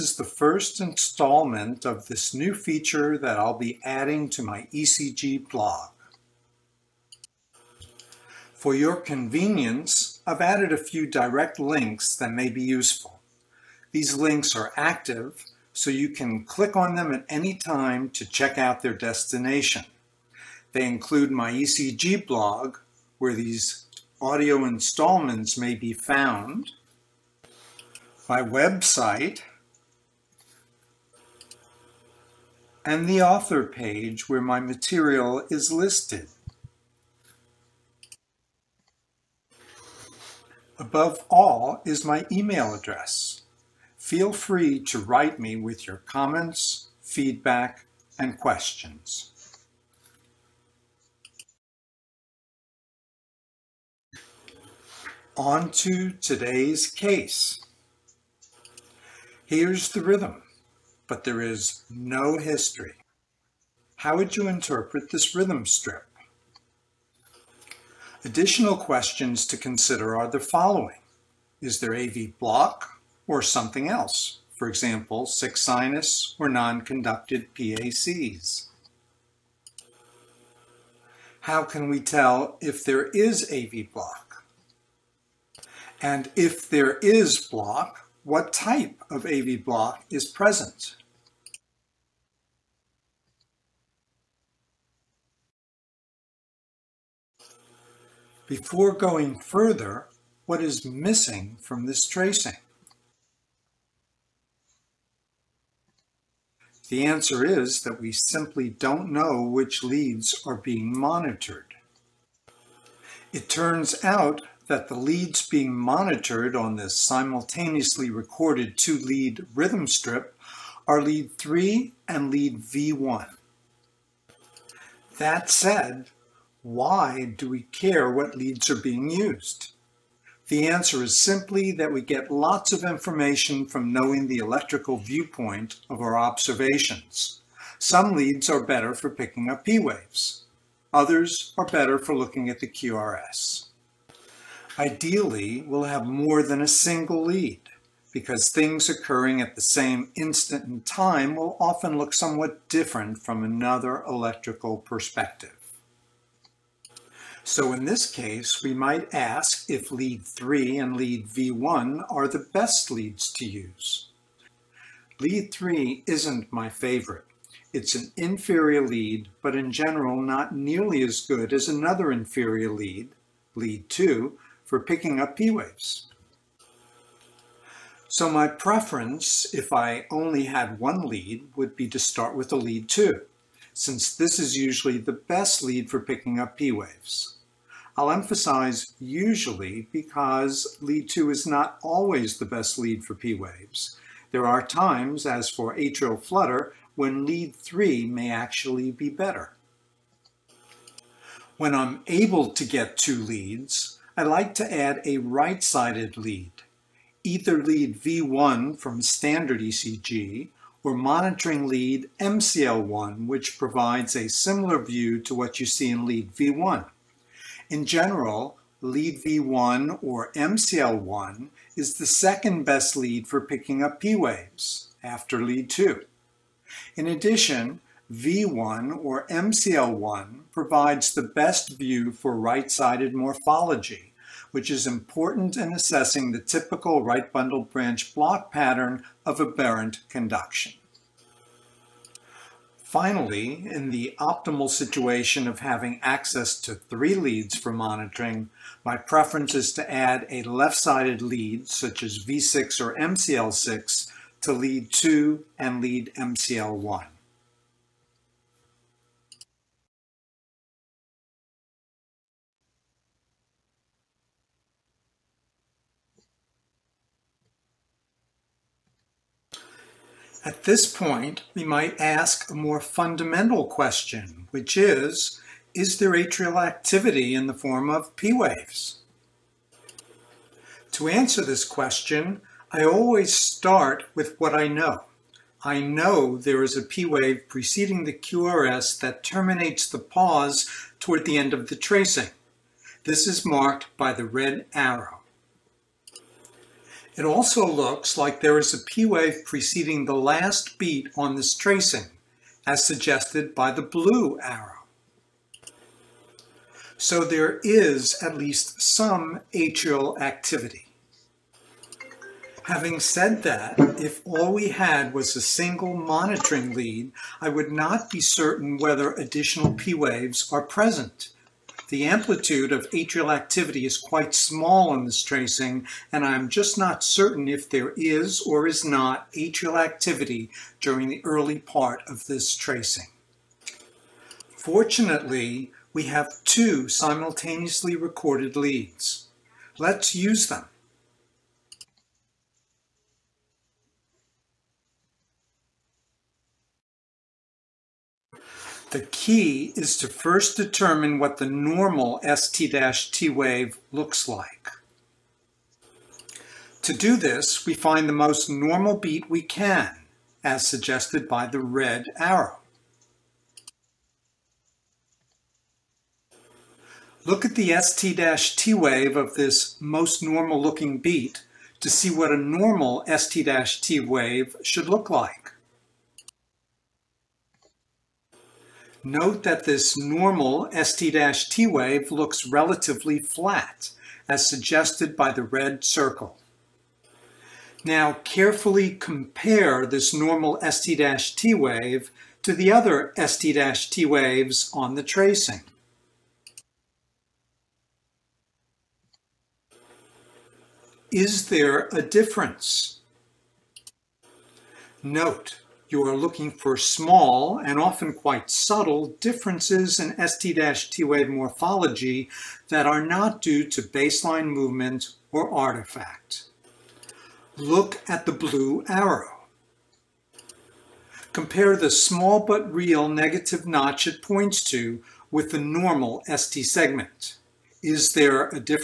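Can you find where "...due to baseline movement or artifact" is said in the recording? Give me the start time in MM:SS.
06:53.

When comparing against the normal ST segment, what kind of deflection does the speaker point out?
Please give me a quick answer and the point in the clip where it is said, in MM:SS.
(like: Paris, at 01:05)
Negative notch, at 07:03.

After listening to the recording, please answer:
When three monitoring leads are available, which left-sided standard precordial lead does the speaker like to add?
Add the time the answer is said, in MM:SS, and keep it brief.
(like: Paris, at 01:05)
V6, at 04:12.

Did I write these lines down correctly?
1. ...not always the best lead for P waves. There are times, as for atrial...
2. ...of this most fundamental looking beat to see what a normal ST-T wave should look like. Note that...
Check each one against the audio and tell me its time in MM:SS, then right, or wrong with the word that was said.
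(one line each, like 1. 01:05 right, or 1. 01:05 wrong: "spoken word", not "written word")
1. 03:11 right
2. 06:09 wrong: "normal", not "fundamental".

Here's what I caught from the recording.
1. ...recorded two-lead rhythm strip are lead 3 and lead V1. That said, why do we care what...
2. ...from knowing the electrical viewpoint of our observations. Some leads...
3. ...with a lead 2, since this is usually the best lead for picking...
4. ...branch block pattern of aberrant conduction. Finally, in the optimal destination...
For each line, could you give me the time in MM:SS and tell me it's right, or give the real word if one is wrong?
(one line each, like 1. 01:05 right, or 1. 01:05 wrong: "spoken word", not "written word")
1. 01:58 right
2. 02:13 right
3. 03:02 right
4. 03:57 wrong: "situation", not "destination".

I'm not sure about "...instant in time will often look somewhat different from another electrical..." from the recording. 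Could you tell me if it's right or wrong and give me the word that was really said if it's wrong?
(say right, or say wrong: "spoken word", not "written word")
right.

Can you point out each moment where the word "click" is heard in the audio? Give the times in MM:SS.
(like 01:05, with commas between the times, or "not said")
00:16.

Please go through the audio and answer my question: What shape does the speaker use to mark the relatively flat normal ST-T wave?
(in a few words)
Circle.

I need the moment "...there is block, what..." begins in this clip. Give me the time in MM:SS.
01:26.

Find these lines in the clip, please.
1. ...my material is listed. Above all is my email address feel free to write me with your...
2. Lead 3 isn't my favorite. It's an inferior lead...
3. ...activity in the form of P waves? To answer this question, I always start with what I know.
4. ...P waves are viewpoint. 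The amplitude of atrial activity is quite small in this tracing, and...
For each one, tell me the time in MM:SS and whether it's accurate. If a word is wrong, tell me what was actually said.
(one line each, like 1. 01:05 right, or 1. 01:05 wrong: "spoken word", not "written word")
1. 00:34 right
2. 02:45 right
3. 04:36 right
4. 05:19 wrong: "present", not "viewpoint".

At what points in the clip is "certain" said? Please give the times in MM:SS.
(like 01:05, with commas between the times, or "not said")
05:18, 05:27.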